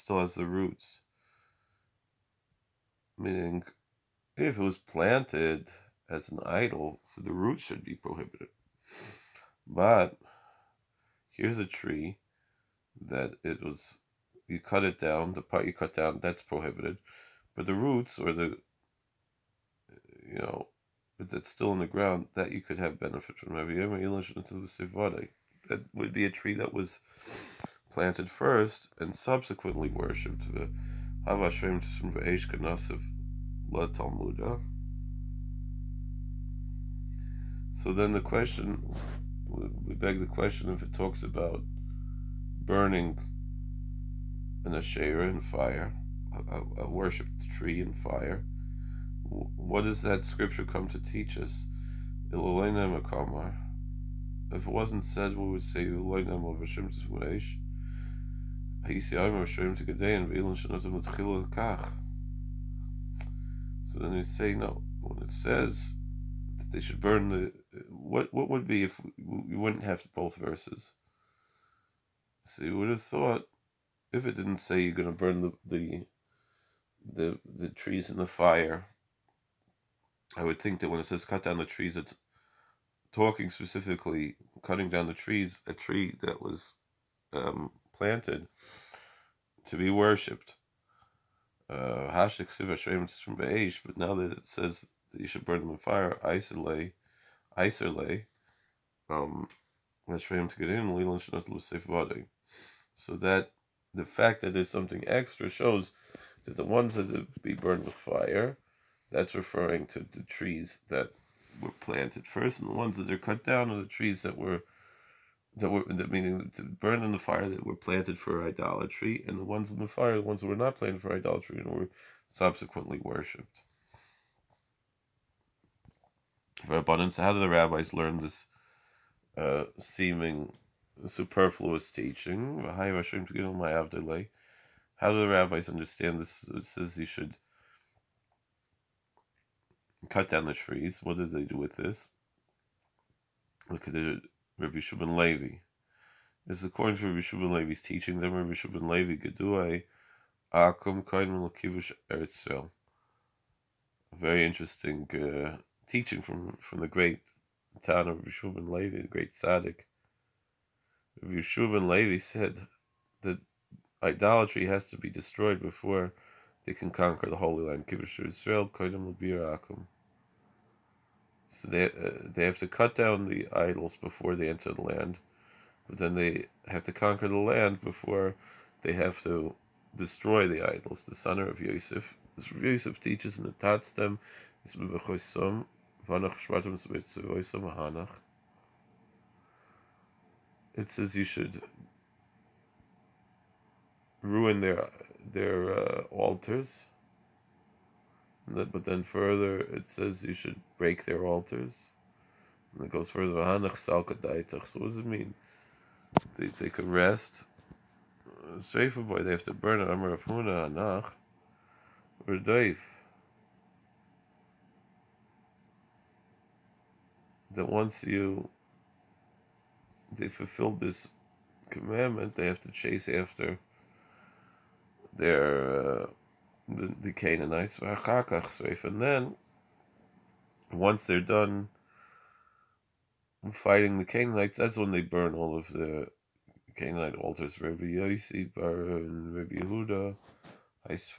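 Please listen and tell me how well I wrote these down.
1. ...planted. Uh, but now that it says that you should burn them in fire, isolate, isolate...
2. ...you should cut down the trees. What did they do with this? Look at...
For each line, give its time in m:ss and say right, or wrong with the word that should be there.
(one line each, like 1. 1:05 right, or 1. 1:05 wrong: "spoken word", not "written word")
1. 1:29 wrong: "worshipped", not "planted"
2. 2:16 right.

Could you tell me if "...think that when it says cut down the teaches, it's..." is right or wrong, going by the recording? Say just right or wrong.
wrong.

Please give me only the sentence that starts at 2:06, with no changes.
For abundance, how do the rabbis learn this uh, seeming superfluous teaching?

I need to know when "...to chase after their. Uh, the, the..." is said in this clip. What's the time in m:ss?
3:42.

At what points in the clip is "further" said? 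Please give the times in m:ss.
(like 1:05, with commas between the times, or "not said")
3:19, 3:23.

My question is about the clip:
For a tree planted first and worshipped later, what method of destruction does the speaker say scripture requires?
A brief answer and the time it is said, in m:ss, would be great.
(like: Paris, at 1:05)
burned with fire, at 1:47.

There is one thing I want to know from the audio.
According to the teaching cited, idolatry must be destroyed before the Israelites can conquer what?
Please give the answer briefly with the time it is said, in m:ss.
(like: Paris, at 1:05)
the Holy Land, at 2:47.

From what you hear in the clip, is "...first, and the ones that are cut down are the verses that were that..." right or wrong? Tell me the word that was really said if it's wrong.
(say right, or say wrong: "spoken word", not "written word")
wrong: "trees", not "verses".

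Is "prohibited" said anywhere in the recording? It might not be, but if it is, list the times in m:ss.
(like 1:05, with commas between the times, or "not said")
0:07, 0:16.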